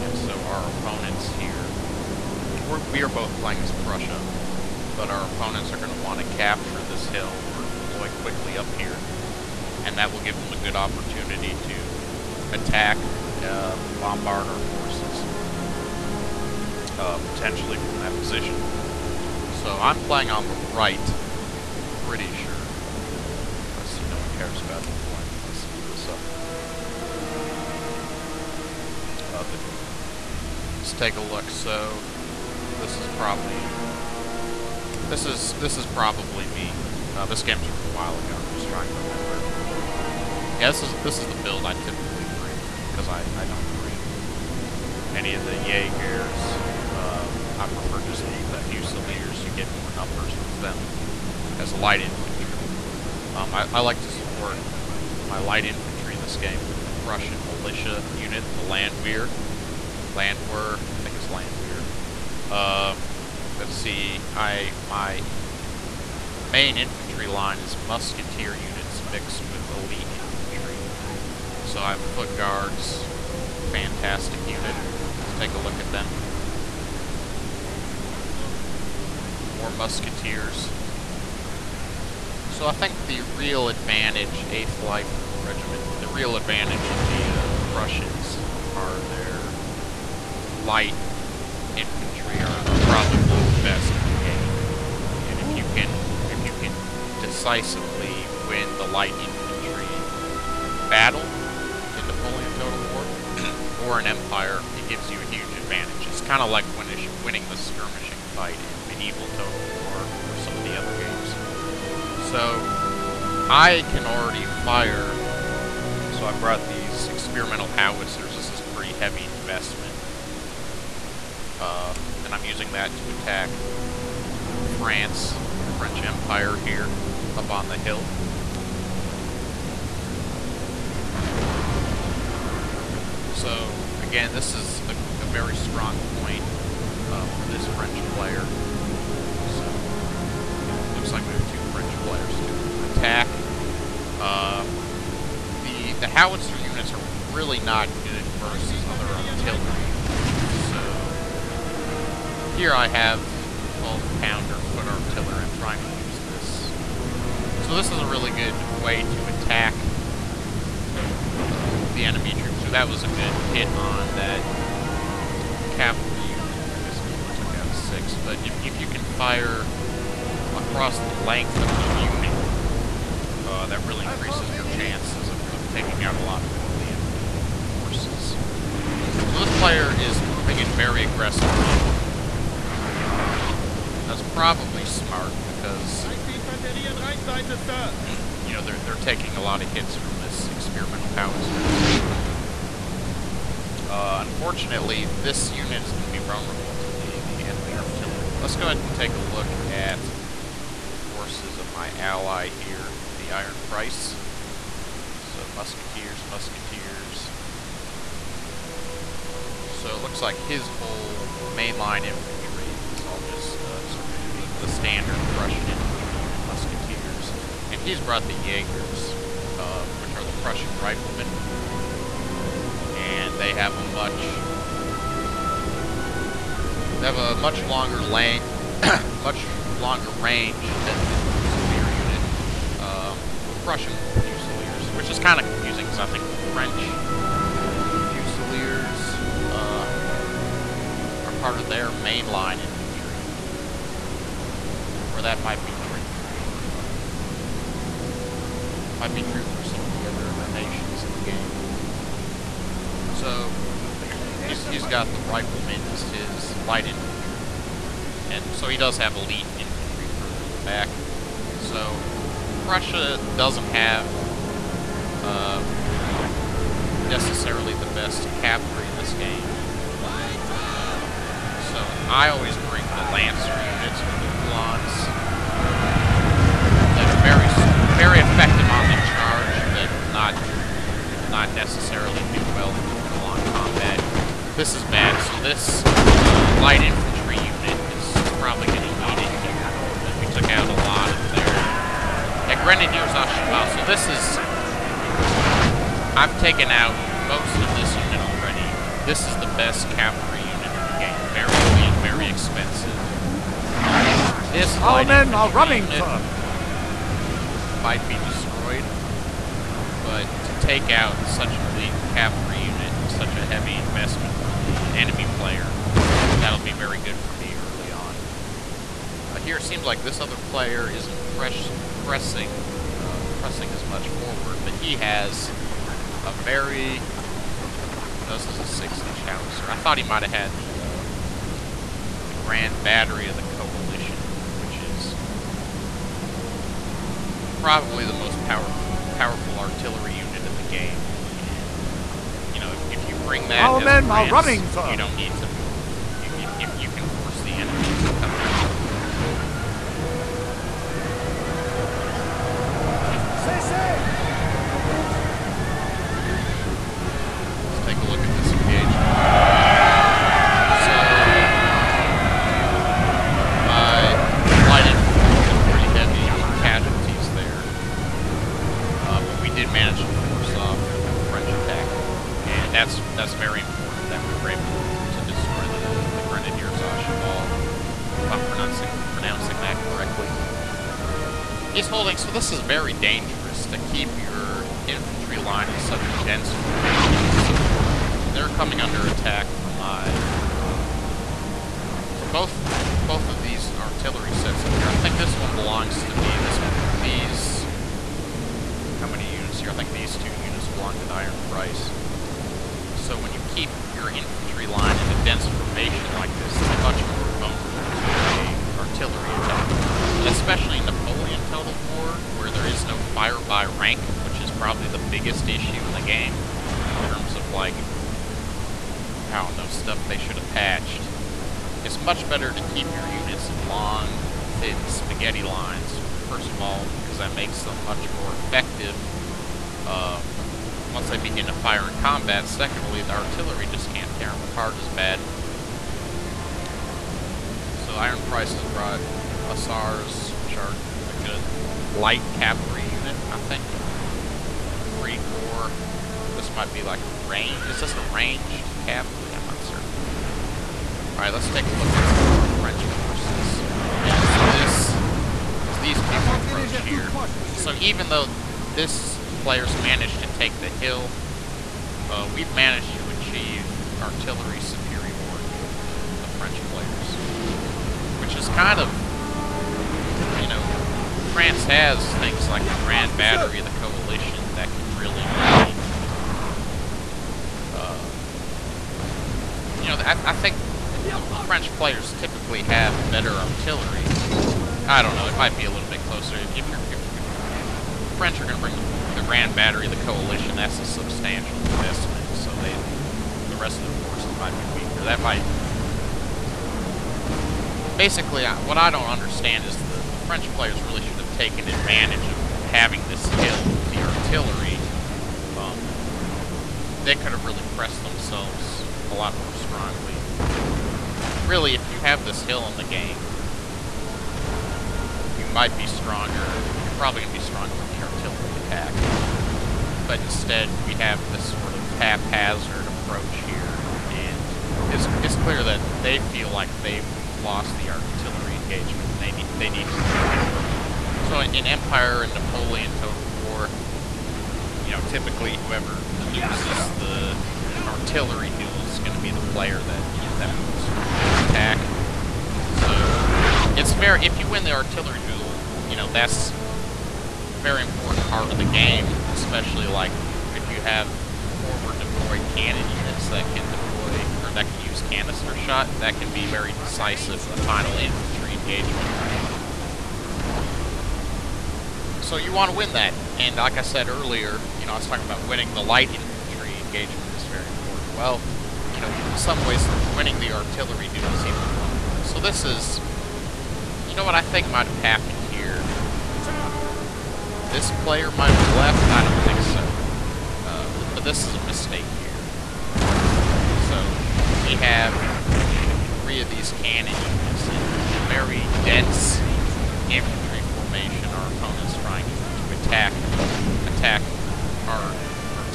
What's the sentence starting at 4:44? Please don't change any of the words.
This is bad, so this uh, light infantry unit is probably going to eat it.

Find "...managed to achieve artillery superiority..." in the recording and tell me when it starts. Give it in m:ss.
7:42.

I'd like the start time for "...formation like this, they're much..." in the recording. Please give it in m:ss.
6:45.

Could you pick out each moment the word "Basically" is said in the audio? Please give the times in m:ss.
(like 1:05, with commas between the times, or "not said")
8:17.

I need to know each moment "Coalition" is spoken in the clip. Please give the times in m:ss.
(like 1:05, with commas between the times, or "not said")
5:33, 7:53, 8:10.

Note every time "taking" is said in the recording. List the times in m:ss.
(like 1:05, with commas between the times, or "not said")
2:55, 3:08.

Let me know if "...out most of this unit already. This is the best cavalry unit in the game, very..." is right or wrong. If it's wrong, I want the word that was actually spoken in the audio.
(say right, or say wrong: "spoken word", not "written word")
right.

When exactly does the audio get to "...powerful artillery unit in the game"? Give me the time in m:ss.
5:39.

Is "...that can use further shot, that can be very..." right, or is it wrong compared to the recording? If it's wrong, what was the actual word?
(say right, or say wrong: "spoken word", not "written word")
wrong: "canister", not "further".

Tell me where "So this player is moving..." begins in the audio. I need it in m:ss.
2:58.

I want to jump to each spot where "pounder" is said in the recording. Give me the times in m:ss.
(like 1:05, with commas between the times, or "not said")
2:33.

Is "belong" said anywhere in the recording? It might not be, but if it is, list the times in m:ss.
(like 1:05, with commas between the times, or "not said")
not said.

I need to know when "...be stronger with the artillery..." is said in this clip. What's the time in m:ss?
8:37.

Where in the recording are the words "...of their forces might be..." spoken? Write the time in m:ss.
8:13.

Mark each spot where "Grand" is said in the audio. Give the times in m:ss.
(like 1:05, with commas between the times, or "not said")
5:32, 7:52, 8:09.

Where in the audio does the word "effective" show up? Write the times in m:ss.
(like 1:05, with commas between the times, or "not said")
4:38, 7:08.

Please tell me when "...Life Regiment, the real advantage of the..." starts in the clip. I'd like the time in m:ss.
1:24.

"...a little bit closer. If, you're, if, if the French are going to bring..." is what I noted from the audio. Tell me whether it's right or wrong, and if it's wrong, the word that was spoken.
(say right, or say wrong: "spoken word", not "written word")
right.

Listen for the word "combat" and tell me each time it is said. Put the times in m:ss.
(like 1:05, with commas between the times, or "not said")
4:43, 7:12.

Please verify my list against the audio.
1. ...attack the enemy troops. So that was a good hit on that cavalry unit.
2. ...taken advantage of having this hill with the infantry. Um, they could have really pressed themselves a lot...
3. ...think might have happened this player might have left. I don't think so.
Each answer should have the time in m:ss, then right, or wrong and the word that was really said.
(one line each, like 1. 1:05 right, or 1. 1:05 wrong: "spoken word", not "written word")
1. 2:39 right
2. 8:21 wrong: "artillery", not "infantry"
3. 9:34 right.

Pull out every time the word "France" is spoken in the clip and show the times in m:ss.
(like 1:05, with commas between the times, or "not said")
2:04, 5:44, 7:51.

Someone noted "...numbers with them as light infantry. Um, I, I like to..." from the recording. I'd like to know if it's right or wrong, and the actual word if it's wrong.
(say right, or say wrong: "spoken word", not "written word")
right.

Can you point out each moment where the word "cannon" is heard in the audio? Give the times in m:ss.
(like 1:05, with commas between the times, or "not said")
9:12, 9:46.